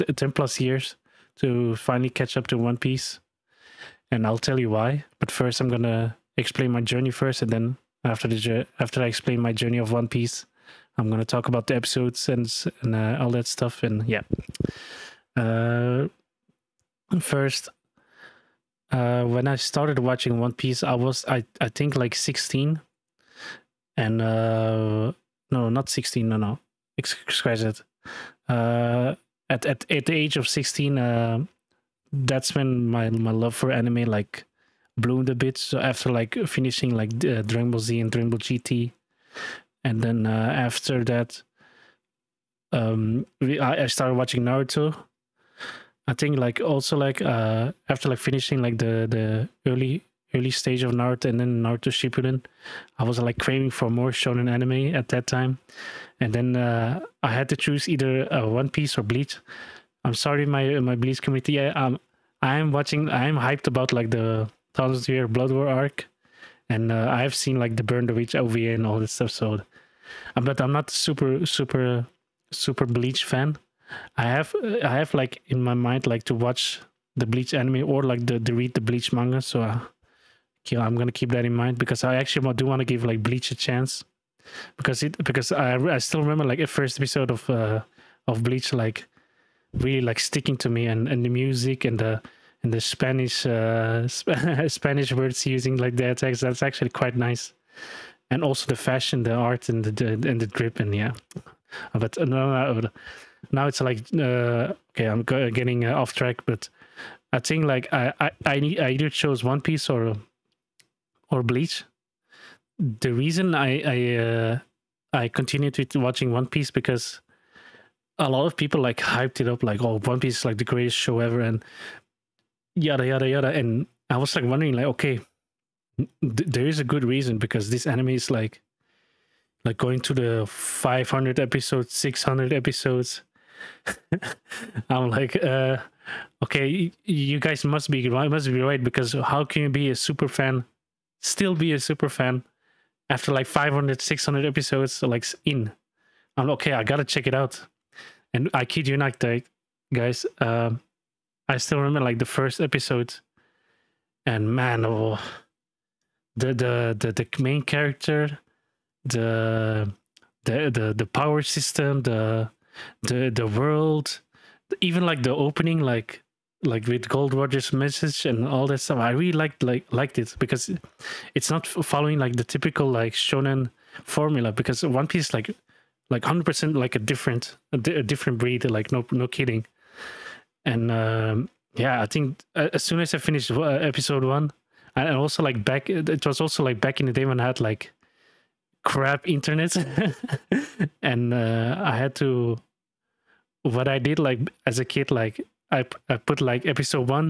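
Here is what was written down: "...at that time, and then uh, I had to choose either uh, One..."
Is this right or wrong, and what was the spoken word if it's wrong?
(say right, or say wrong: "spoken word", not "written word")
right.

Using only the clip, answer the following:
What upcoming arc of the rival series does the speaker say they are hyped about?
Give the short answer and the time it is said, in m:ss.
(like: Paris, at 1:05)
Thousand Year Blood War, at 1:04.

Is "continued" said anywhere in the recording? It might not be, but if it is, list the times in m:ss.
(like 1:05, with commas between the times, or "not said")
1:55.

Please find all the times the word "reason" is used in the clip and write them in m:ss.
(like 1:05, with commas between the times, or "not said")
1:53, 2:07.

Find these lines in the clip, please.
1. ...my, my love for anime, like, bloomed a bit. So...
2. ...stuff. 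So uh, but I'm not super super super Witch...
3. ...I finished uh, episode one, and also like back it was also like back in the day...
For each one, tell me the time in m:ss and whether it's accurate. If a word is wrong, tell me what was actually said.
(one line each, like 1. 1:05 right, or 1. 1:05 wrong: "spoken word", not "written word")
1. 0:32 right
2. 1:09 wrong: "Bleach", not "Witch"
3. 3:03 right.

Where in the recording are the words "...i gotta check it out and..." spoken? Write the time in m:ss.
2:26.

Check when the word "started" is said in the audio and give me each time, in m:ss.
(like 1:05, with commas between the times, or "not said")
0:19, 0:43.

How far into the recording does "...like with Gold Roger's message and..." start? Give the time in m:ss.
2:46.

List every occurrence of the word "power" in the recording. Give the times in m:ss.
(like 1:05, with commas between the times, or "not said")
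2:41.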